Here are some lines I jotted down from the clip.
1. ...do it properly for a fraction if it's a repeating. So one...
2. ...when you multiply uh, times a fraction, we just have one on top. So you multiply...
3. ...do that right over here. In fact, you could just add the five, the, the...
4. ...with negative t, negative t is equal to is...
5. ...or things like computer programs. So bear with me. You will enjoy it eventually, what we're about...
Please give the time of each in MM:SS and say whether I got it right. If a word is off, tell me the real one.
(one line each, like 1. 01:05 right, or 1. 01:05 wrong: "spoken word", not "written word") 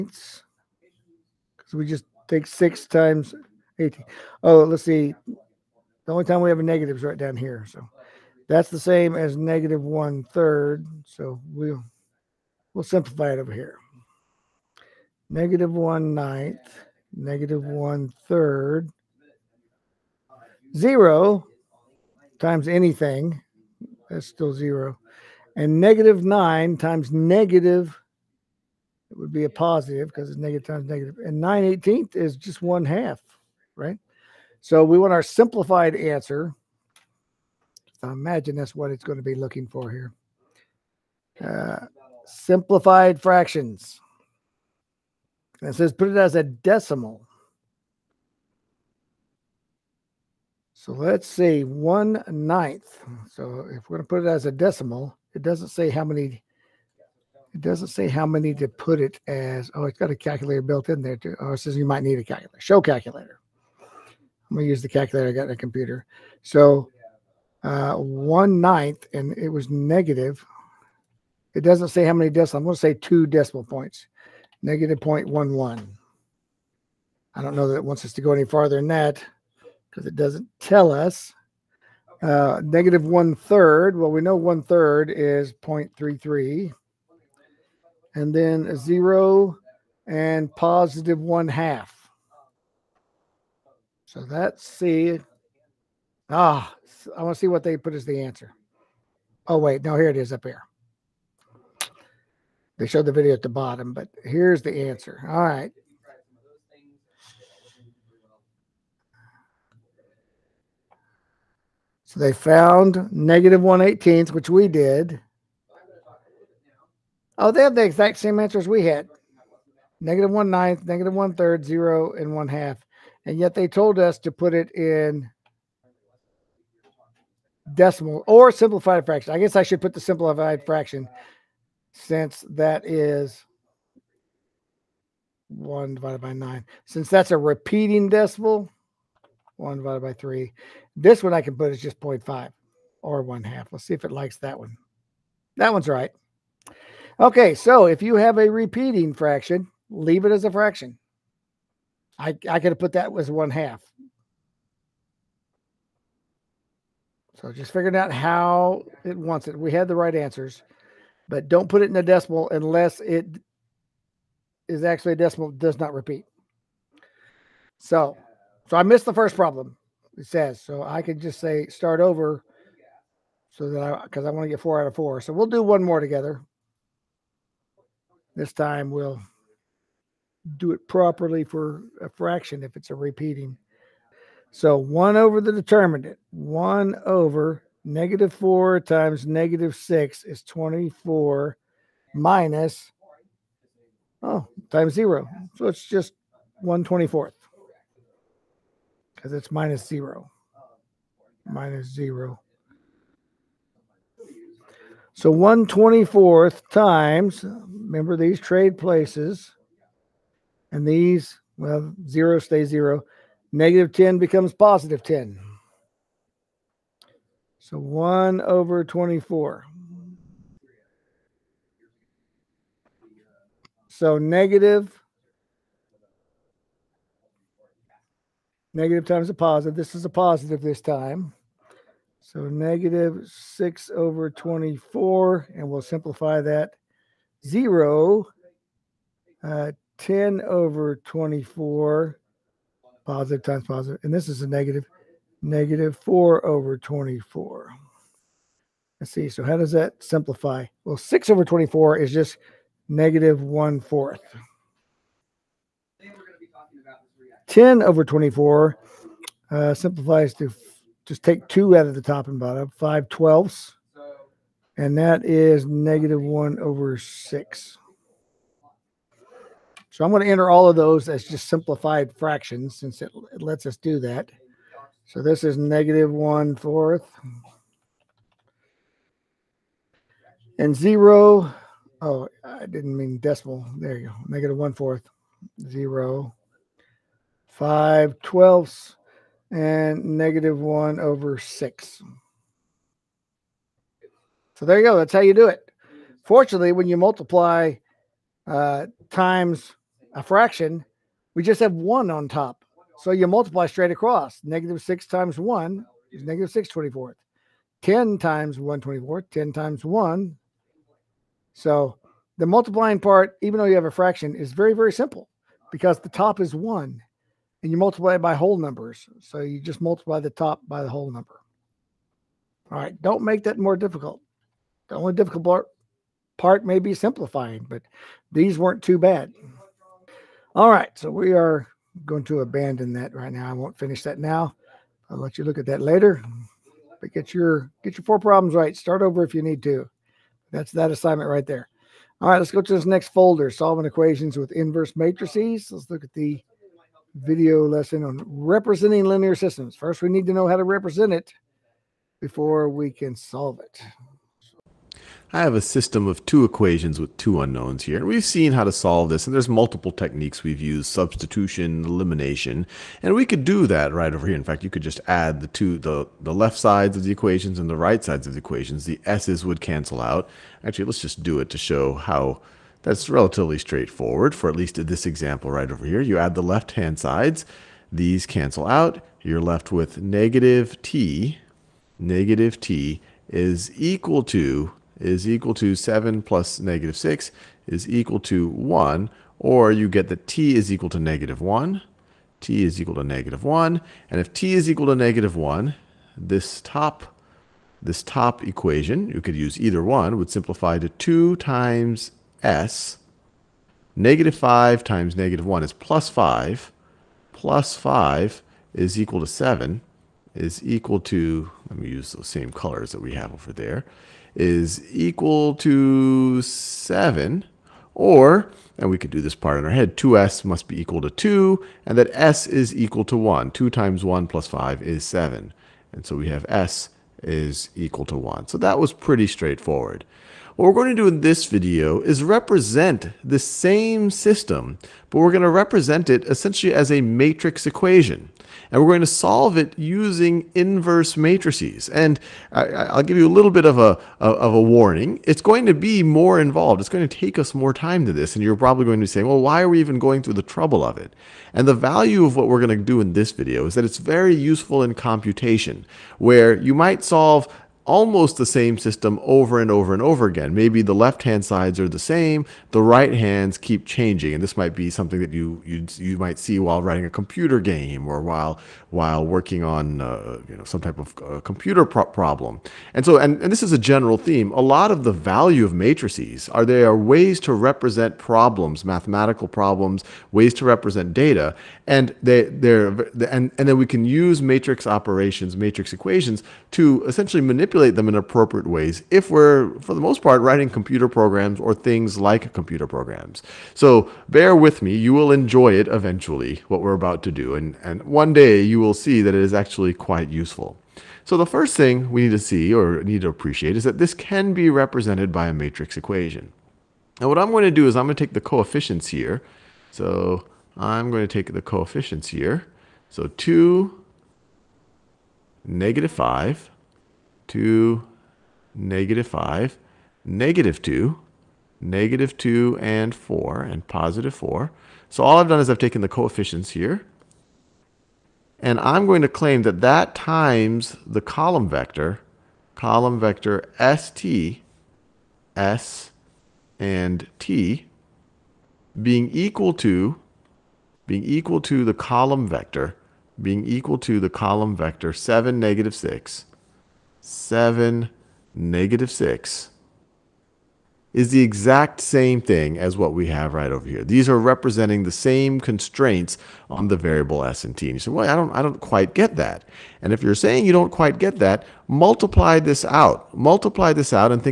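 1. 03:00 right
2. 04:56 right
3. 06:03 wrong: "two", not "five"
4. 06:19 right
5. 08:11 right.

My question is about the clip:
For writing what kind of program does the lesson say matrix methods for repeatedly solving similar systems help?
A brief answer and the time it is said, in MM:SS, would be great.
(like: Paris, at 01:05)
computer game, at 07:47.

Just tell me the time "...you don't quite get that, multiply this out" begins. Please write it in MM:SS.
09:20.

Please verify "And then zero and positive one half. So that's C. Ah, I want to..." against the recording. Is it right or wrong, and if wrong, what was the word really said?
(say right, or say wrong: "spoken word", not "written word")
right.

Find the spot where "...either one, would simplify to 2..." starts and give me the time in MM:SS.
06:39.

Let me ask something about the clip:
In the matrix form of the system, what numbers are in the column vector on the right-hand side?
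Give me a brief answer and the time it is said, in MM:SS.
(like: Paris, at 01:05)
7, -6, at 09:05.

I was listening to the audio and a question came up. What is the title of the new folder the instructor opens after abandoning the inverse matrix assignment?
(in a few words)
solving equations with inverse matrices.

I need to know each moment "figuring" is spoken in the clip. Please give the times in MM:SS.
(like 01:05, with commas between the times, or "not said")
02:37.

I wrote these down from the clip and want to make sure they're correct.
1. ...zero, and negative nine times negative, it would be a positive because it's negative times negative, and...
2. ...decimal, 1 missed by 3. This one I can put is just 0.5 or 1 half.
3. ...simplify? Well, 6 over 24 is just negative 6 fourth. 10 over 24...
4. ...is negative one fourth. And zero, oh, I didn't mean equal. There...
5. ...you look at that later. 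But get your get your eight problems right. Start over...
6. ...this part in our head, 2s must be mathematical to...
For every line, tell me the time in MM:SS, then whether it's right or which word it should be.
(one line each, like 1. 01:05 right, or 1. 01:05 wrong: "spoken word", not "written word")
1. 00:24 right
2. 02:18 wrong: "divided", not "missed"
3. 04:10 wrong: "1", not "6"
4. 04:35 wrong: "decimal", not "equal"
5. 05:35 wrong: "four", not "eight"
6. 06:59 wrong: "equal", not "mathematical".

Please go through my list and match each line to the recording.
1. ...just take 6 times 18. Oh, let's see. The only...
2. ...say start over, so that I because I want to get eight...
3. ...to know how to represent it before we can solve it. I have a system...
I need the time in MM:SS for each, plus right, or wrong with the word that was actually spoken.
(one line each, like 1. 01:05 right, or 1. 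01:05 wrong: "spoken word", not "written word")
1. 00:01 right
2. 02:51 wrong: "four", not "eight"
3. 05:50 right.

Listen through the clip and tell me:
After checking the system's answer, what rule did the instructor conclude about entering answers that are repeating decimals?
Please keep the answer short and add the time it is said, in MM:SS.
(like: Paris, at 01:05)
leave it as a fraction, at 02:29.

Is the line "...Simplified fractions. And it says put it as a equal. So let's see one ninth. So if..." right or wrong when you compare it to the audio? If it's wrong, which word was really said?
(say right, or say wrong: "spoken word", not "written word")
wrong: "decimal", not "equal".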